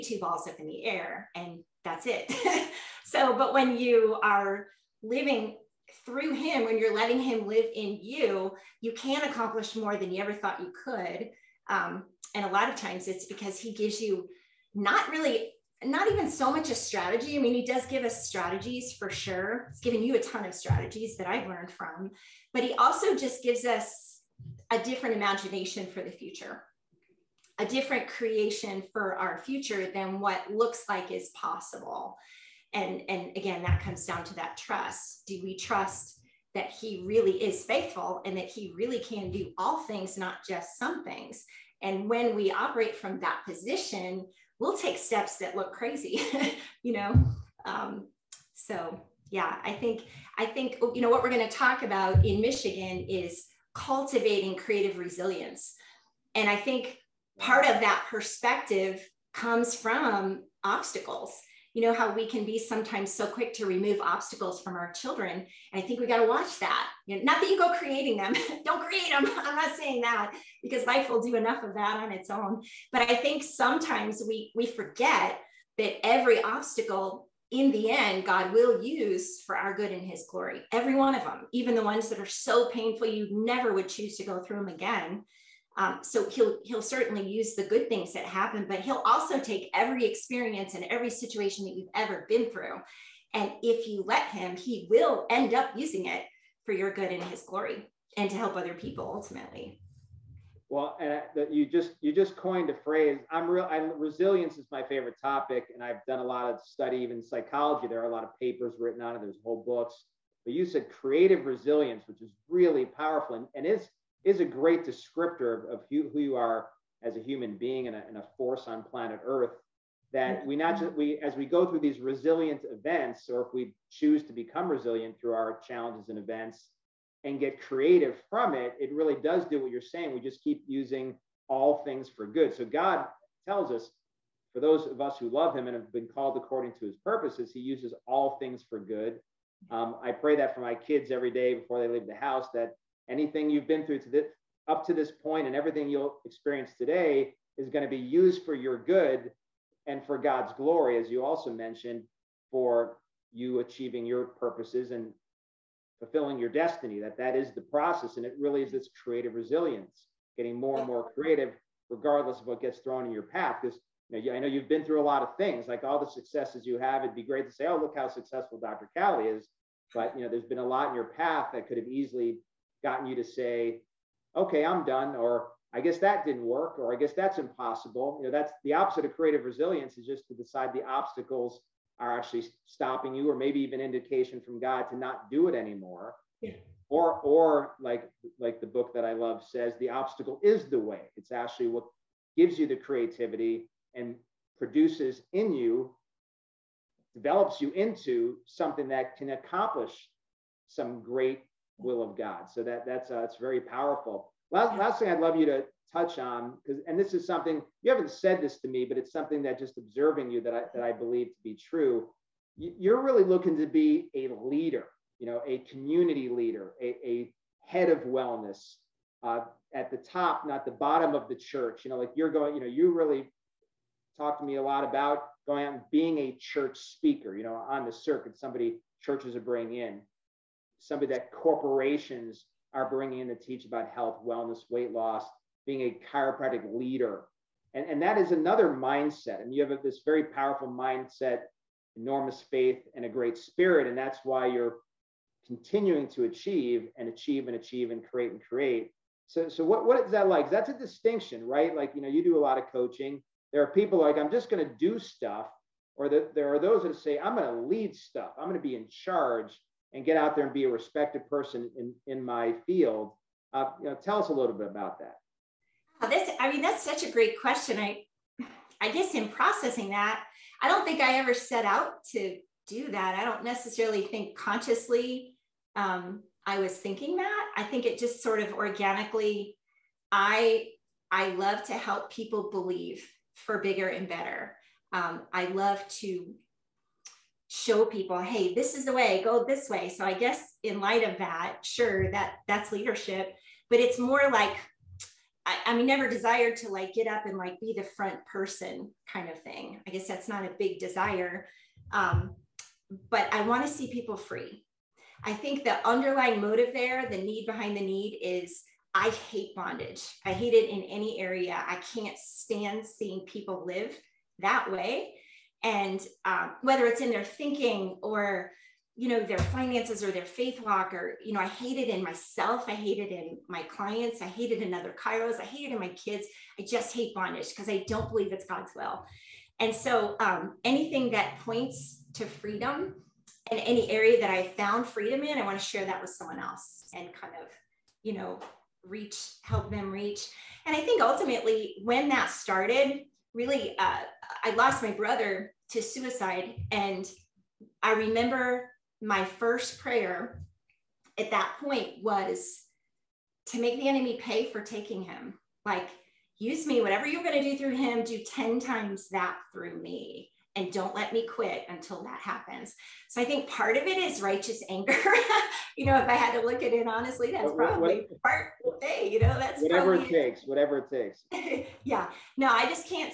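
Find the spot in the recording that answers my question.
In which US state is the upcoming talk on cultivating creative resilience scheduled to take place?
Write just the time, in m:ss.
0:52.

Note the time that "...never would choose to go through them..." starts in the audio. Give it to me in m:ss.
1:23.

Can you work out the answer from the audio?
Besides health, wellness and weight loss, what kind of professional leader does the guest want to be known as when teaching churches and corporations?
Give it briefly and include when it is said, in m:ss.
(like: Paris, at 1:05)
Chiropractic leader, at 3:56.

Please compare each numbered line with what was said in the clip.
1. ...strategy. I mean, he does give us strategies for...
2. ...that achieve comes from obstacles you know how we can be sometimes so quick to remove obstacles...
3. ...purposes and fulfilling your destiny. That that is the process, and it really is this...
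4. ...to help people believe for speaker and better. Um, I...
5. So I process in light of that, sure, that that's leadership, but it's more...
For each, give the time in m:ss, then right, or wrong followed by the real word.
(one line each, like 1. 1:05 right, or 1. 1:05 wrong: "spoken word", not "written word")
1. 0:16 right
2. 0:57 wrong: "perspective", not "achieve"
3. 2:34 right
4. 4:41 wrong: "bigger", not "speaker"
5. 4:49 wrong: "guess", not "process".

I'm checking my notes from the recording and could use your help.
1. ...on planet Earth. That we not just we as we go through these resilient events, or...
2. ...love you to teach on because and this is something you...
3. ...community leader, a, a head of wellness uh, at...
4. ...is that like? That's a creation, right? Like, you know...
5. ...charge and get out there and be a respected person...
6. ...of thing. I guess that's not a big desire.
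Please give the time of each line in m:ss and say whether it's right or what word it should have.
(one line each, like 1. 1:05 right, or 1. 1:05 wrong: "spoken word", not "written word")
1. 1:58 right
2. 3:25 wrong: "touch", not "teach"
3. 3:35 right
4. 4:10 wrong: "distinction", not "creation"
5. 4:18 right
6. 4:59 right.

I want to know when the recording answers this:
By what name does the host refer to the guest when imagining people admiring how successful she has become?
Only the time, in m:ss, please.
2:48.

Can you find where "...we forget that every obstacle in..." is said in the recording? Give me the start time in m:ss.
1:14.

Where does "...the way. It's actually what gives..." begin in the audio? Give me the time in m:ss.
3:10.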